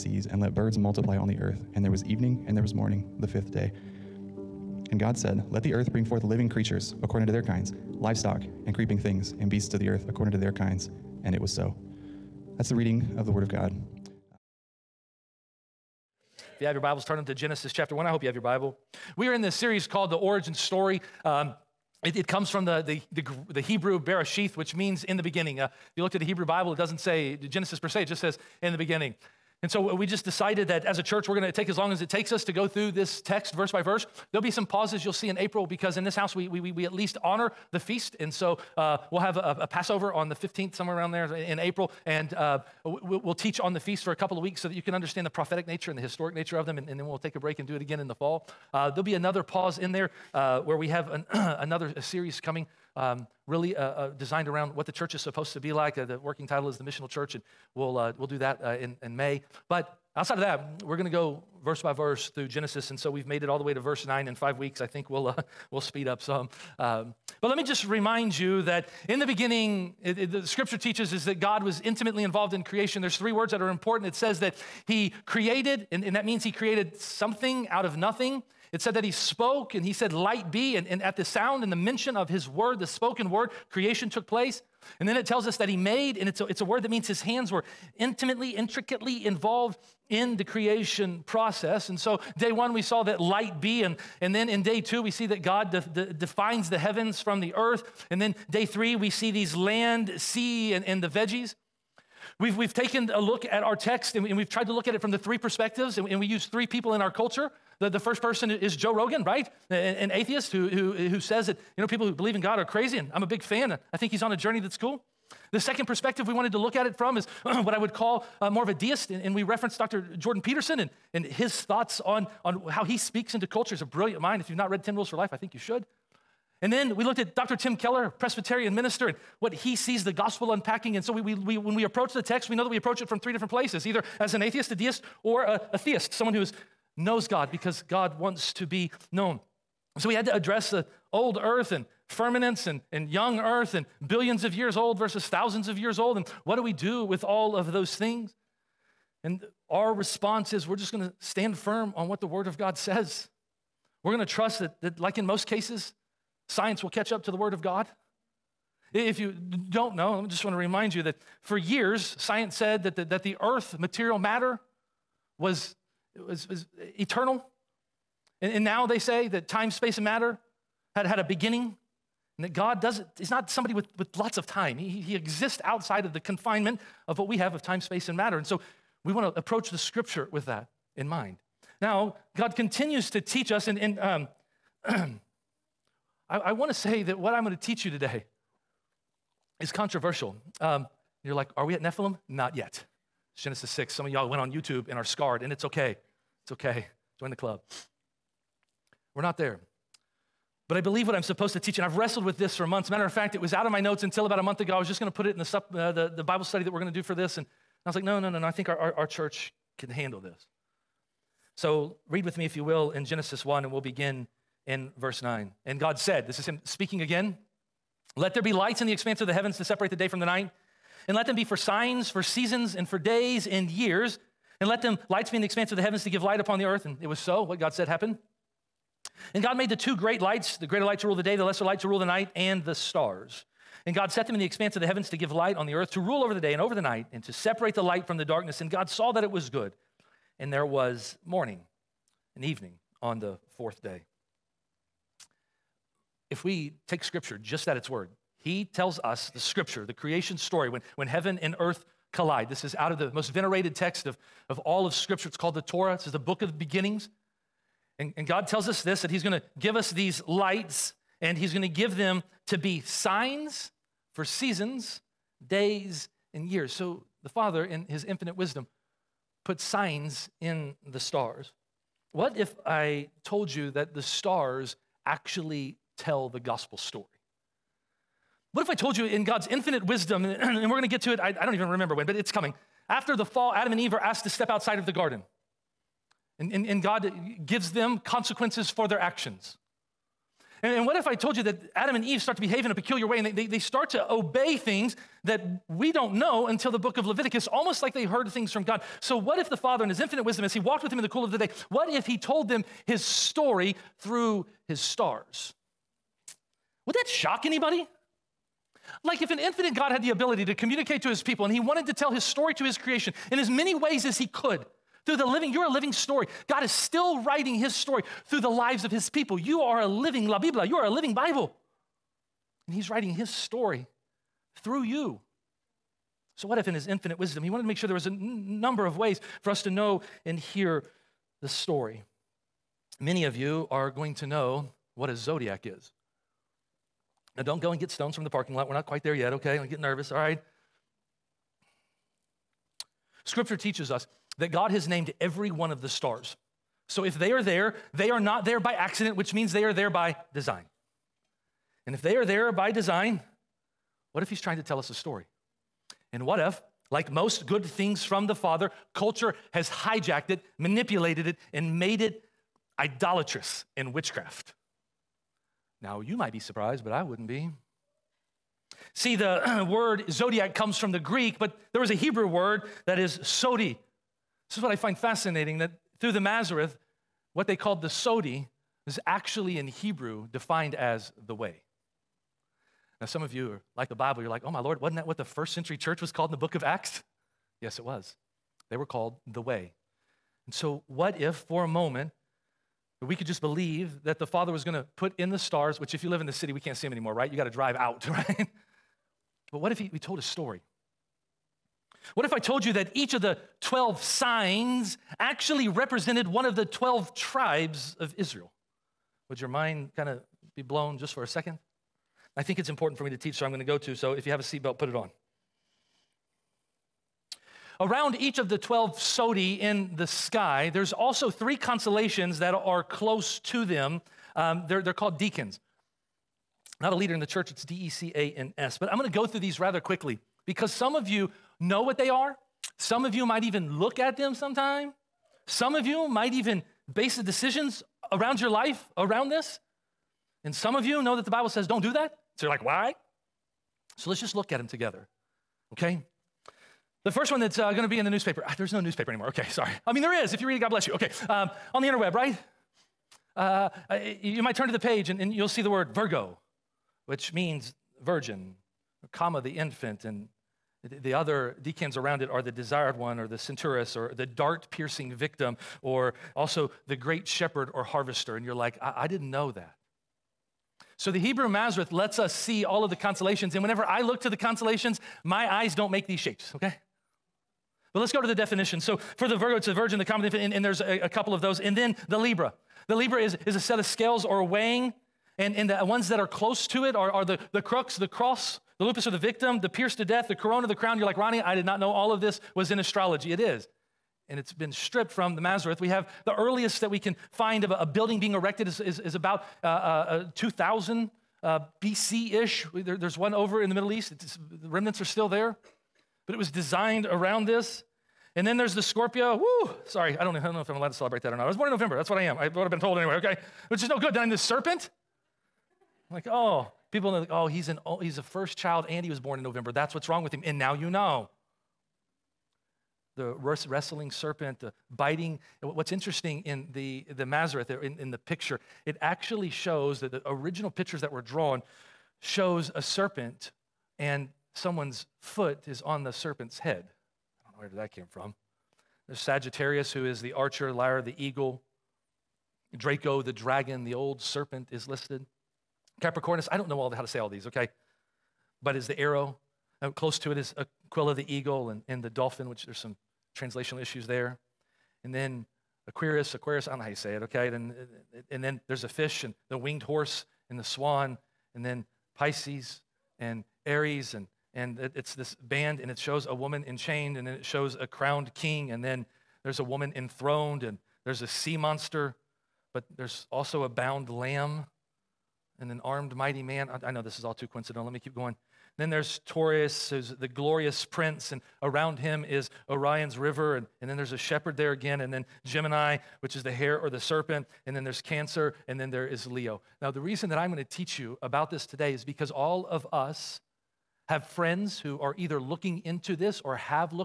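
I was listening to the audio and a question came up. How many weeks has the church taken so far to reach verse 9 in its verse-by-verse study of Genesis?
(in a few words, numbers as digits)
5.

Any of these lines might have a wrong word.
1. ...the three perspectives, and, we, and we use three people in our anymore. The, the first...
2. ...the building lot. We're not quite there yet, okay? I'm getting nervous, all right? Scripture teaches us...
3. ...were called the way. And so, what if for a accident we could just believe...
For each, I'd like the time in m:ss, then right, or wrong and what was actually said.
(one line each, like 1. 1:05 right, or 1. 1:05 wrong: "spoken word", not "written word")
1. 1:45 wrong: "culture", not "anymore"
2. 5:38 wrong: "parking", not "building"
3. 6:28 wrong: "moment", not "accident".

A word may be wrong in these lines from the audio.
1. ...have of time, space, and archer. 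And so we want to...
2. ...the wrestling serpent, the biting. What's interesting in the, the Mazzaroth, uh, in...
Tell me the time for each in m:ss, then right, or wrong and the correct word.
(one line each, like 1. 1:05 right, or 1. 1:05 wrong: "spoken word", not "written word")
1. 2:57 wrong: "matter", not "archer"
2. 8:43 right.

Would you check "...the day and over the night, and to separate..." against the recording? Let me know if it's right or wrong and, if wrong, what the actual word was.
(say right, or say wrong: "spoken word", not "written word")
right.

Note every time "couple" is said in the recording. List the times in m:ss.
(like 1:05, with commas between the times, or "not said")
0:44, 8:01.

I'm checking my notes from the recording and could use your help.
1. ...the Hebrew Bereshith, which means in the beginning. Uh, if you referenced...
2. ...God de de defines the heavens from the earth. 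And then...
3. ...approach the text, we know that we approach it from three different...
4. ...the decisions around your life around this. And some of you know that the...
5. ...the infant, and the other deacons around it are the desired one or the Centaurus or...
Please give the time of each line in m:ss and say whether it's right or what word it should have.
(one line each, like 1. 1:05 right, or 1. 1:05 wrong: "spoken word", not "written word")
1. 0:23 wrong: "looked", not "referenced"
2. 1:35 right
3. 2:11 right
4. 7:17 right
5. 7:39 right.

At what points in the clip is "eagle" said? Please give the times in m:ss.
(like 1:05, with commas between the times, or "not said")
9:01, 9:11.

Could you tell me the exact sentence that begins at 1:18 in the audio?
It said that he spoke and he said, Light be.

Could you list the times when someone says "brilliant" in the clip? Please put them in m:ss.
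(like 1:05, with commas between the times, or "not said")
2:03.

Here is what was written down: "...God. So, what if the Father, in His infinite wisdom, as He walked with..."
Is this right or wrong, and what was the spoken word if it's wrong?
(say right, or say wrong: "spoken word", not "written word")
right.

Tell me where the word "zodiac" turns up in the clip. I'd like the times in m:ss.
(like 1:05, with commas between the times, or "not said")
5:35, 6:10.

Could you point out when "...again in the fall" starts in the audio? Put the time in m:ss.
0:47.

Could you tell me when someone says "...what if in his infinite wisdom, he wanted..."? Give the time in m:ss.
5:26.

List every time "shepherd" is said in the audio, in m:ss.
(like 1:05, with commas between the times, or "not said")
7:47, 9:44.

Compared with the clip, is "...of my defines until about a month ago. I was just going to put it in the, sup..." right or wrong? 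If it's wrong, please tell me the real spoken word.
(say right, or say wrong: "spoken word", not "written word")
wrong: "notes", not "defines".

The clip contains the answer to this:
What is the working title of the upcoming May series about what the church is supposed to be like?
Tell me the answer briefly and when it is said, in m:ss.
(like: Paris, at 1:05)
The Missional Church, at 0:56.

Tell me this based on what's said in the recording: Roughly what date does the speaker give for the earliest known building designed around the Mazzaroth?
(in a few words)
2000 BC.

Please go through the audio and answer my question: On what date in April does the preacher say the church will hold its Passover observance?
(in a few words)
the 15th.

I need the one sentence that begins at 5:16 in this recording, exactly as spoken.
God is still writing his story through the lives of his people.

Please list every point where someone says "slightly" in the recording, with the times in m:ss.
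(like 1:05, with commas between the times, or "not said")
not said.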